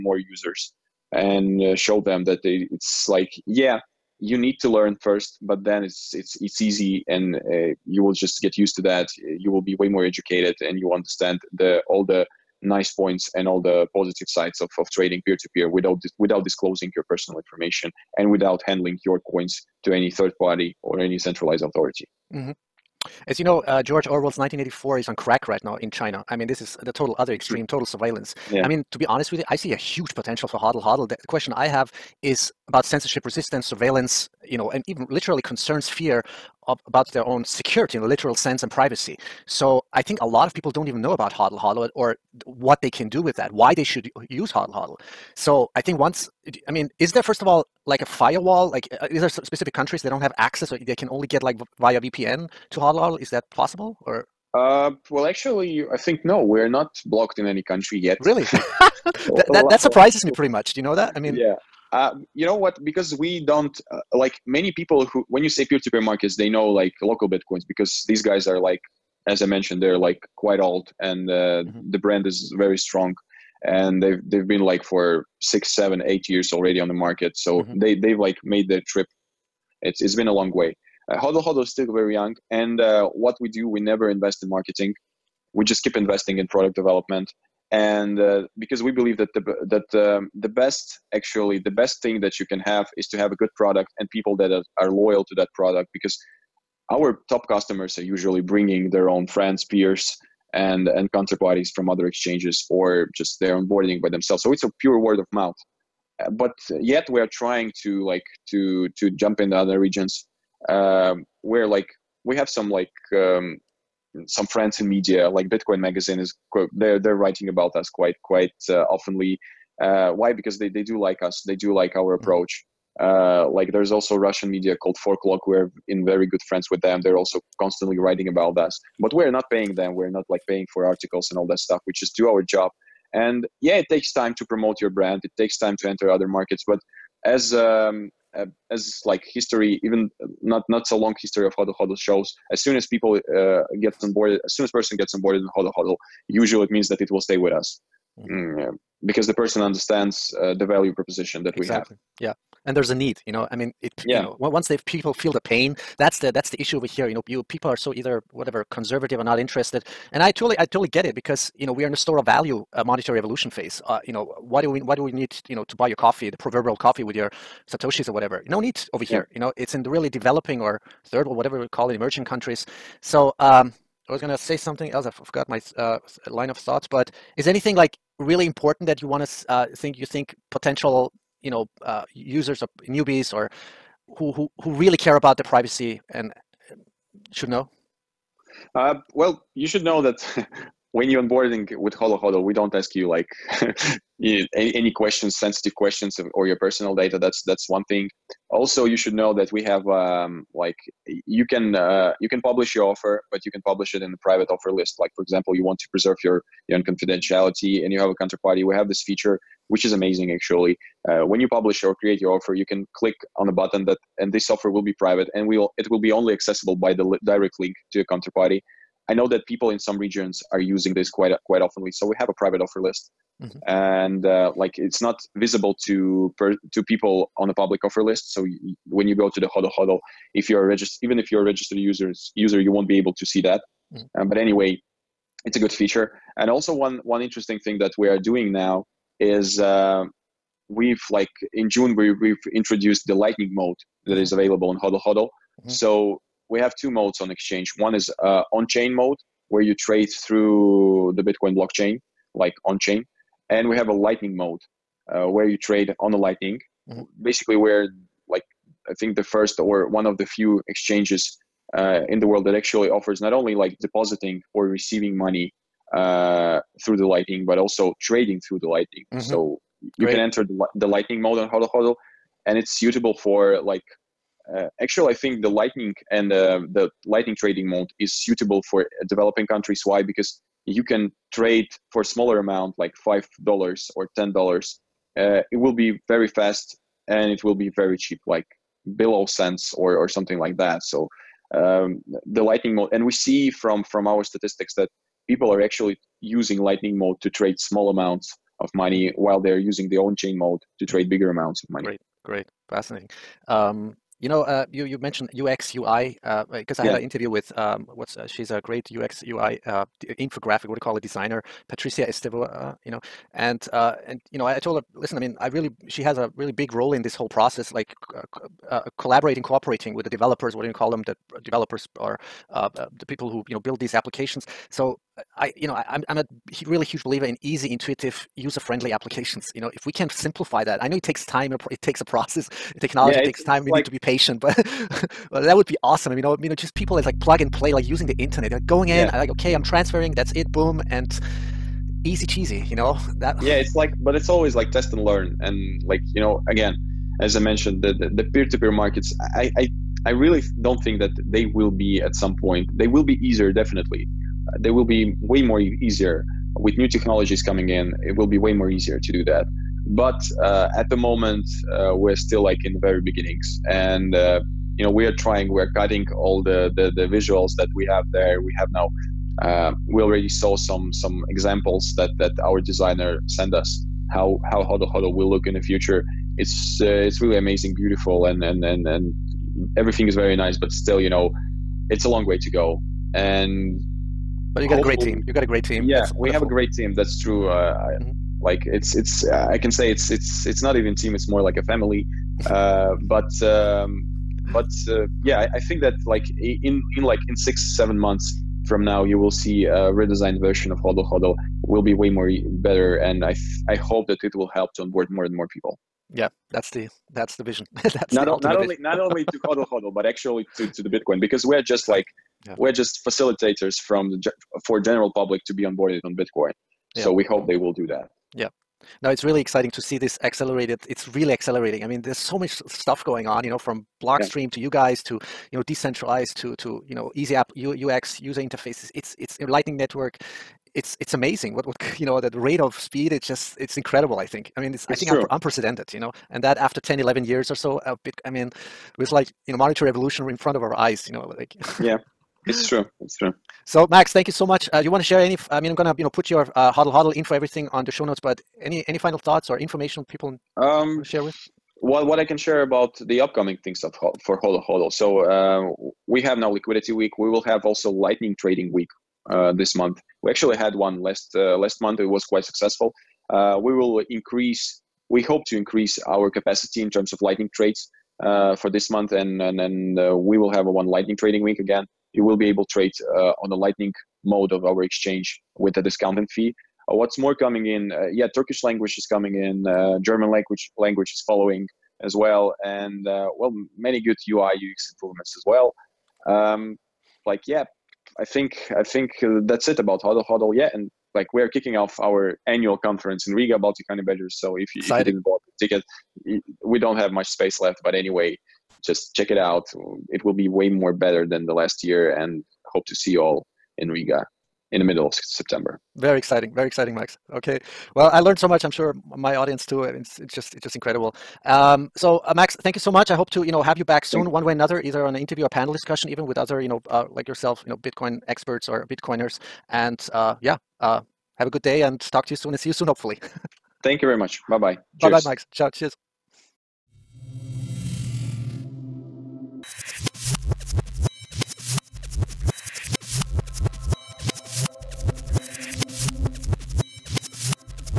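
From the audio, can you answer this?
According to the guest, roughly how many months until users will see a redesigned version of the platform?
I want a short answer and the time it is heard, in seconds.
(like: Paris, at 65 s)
6 or 7 months, at 397 s.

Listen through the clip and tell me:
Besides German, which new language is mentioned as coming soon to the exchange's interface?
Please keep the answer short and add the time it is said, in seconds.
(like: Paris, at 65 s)
Turkish, at 478 s.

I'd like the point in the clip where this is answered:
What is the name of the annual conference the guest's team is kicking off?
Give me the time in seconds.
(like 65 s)
493 s.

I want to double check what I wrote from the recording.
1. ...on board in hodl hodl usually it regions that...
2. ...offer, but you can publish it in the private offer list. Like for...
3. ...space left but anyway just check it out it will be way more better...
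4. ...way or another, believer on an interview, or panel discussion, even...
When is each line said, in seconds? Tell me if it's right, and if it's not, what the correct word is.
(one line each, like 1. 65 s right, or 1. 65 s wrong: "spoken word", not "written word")
1. 145 s wrong: "means", not "regions"
2. 202 s right
3. 497 s right
4. 514 s wrong: "either", not "believer".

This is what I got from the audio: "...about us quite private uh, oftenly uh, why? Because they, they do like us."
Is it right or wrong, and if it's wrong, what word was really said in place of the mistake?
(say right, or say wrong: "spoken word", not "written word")
wrong: "quite", not "private".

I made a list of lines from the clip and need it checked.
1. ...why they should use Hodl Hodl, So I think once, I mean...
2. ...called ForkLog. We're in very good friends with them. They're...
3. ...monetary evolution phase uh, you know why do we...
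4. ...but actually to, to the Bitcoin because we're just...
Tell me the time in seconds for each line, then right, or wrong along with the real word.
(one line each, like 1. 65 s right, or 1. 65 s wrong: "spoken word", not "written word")
1. 43 s right
2. 124 s right
3. 162 s right
4. 409 s right.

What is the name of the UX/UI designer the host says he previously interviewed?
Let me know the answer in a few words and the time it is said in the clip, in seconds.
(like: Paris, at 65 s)
Patricia Estevão, at 311 s.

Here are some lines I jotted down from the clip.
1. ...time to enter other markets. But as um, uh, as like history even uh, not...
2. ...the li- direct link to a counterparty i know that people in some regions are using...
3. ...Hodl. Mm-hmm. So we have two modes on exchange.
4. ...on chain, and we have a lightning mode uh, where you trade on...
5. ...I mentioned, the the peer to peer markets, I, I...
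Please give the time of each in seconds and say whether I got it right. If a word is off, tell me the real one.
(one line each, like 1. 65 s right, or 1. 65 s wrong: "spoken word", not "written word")
1. 135 s right
2. 216 s right
3. 245 s right
4. 252 s right
5. 347 s right.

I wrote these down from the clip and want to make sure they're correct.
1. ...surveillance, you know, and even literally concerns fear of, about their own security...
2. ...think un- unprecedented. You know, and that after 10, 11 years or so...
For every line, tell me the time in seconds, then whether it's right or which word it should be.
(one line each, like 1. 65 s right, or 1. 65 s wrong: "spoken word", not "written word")
1. 33 s right
2. 435 s right.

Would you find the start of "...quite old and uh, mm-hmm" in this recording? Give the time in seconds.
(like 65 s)
70 s.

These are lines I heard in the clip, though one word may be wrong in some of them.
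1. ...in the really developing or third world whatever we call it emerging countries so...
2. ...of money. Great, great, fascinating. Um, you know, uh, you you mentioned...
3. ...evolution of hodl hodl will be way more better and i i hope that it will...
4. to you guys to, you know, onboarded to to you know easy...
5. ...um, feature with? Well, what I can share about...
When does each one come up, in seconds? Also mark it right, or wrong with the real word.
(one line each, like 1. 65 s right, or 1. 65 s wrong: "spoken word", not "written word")
1. 169 s right
2. 301 s right
3. 400 s wrong: "version", not "evolution"
4. 424 s wrong: "decentralized", not "onboarded"
5. 450 s wrong: "share", not "feature".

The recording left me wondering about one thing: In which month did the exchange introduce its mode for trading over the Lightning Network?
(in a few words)
June.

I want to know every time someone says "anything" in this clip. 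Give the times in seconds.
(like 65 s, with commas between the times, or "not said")
177 s.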